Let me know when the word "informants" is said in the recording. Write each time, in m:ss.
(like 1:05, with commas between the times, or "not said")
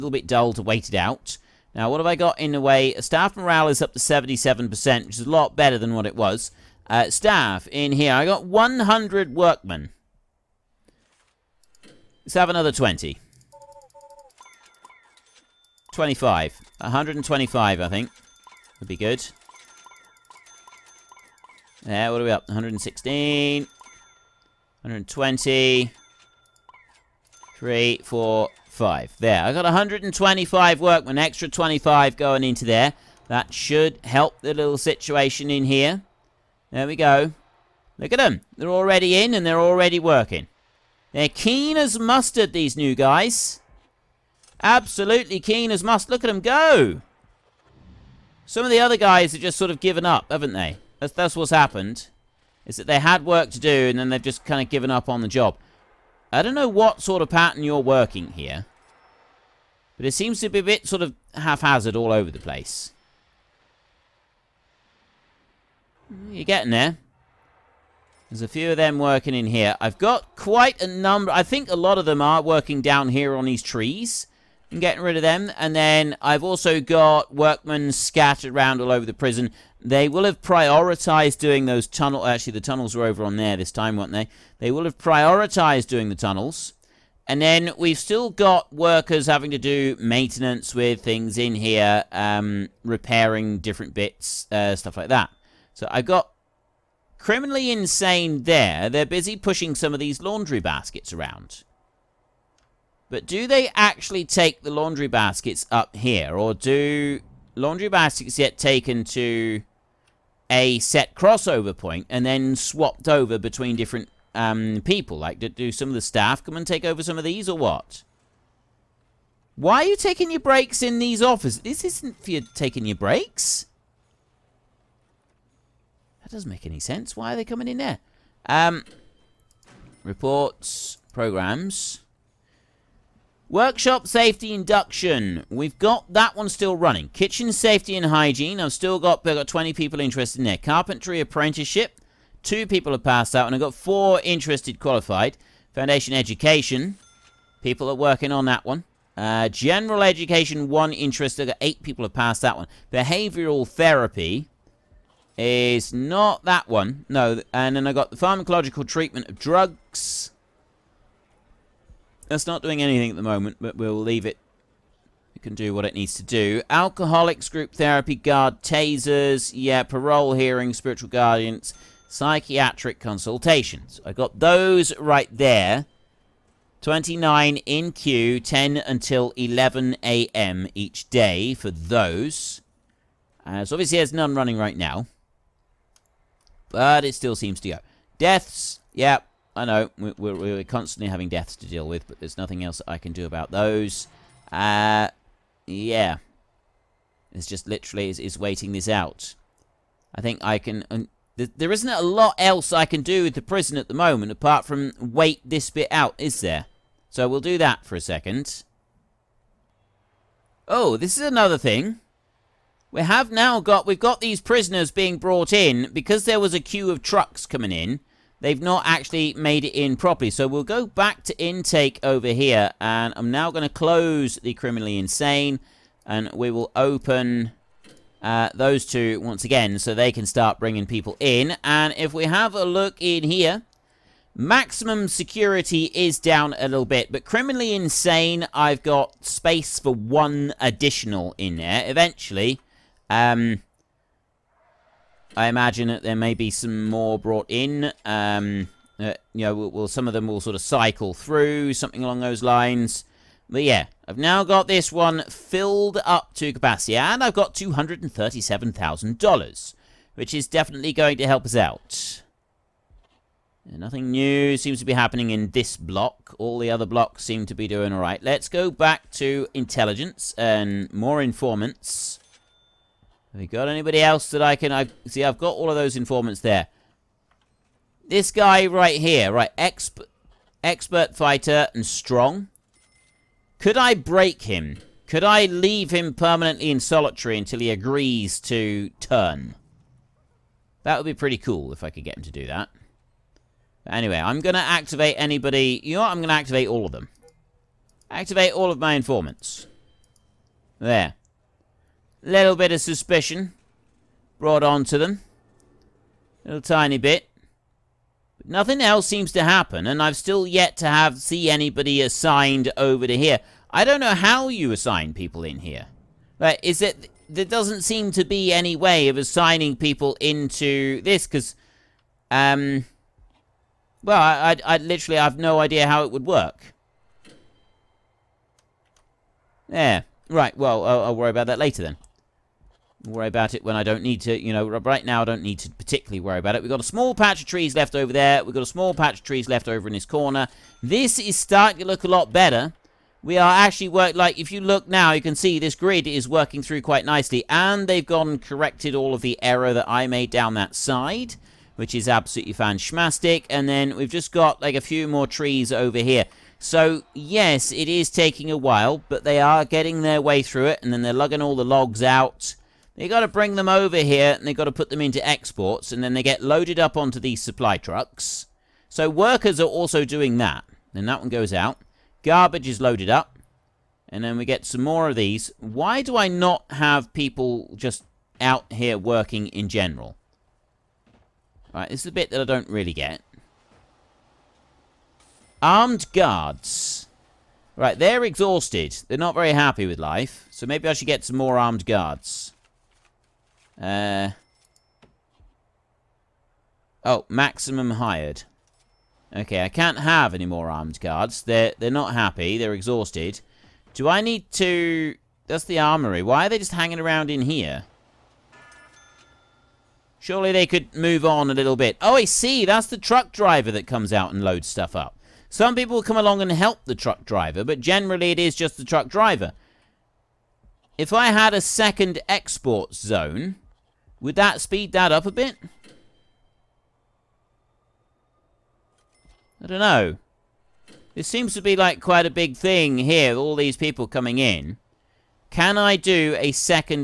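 4:31, 4:35, 4:58.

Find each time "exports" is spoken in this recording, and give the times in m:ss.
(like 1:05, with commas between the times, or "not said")
6:05, 7:02.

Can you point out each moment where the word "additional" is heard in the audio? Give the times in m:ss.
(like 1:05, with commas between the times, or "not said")
4:00.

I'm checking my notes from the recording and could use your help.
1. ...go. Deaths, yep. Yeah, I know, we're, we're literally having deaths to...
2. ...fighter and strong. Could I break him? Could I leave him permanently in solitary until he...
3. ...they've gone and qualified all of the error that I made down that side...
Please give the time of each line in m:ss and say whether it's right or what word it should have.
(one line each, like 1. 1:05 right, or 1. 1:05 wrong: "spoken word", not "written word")
1. 3:07 wrong: "constantly", not "literally"
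2. 4:41 right
3. 5:47 wrong: "corrected", not "qualified".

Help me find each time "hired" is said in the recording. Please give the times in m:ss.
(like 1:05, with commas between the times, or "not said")
6:37.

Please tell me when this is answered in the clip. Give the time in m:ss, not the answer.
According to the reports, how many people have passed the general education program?
2:31.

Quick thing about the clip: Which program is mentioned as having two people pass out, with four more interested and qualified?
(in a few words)
Carpentry apprenticeship.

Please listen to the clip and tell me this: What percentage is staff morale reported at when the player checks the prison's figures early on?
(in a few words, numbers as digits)
77%.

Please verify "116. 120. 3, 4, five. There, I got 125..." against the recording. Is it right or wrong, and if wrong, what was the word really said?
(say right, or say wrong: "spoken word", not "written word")
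right.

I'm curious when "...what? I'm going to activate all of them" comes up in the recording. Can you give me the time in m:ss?
4:55.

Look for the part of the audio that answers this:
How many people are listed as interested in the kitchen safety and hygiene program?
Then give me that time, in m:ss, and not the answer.
2:19.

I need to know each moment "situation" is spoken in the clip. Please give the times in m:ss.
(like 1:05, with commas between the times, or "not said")
0:34.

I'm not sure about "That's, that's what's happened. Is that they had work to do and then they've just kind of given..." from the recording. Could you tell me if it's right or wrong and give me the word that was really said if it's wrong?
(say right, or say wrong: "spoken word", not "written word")
right.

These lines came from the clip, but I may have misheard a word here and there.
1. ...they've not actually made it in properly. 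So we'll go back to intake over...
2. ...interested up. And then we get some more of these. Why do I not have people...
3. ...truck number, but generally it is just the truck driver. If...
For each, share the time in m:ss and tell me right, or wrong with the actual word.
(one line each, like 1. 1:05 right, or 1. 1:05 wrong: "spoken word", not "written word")
1. 3:38 right
2. 6:12 wrong: "loaded", not "interested"
3. 6:56 wrong: "driver", not "number".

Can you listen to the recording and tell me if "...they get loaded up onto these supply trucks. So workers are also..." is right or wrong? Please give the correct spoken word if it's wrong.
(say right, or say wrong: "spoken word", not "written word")
right.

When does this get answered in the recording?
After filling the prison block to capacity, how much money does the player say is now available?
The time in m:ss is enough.
4:17.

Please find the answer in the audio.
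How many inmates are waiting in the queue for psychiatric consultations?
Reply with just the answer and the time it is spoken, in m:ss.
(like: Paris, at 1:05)
29, at 2:56.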